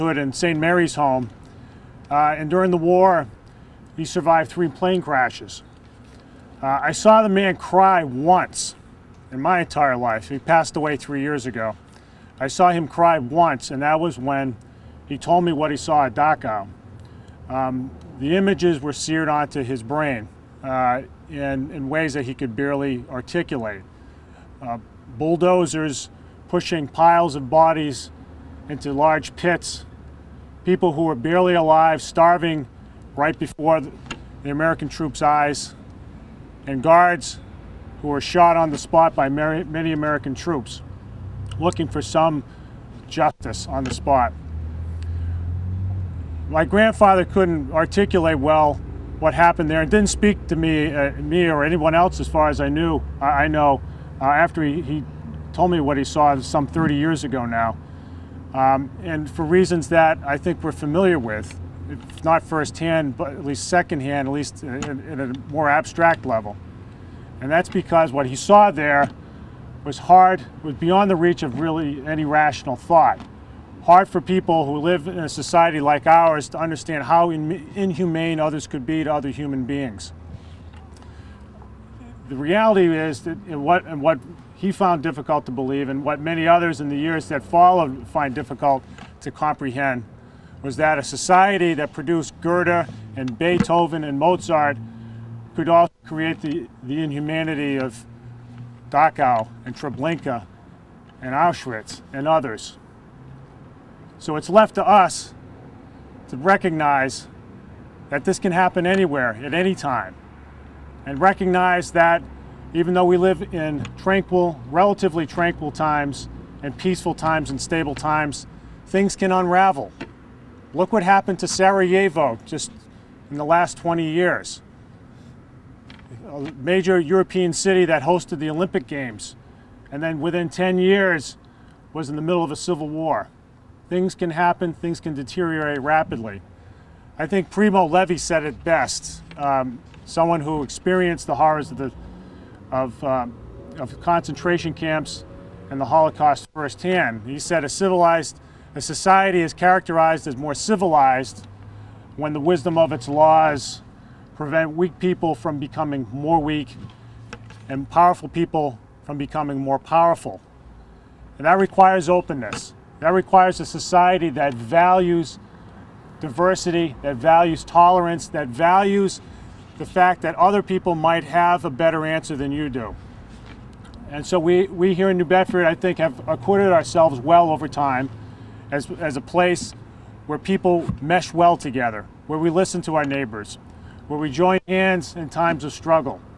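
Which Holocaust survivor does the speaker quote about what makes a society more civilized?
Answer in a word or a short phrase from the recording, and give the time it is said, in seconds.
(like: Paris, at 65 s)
Primo Levi, at 137 s.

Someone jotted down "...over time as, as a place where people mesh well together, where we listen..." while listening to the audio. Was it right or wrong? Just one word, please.
right.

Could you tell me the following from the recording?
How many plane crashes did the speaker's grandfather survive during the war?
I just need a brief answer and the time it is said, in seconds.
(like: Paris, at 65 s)
3, at 4 s.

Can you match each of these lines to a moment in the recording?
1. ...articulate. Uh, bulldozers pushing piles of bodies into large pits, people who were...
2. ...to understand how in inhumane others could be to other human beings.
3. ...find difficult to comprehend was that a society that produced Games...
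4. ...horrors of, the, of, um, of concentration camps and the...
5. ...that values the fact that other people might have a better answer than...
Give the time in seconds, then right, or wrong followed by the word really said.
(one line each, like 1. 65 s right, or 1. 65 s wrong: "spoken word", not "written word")
1. 23 s right
2. 76 s right
3. 88 s wrong: "Goethe", not "Games"
4. 141 s right
5. 168 s right.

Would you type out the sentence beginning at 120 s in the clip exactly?
Look what happened to Sarajevo just in the last 20 years.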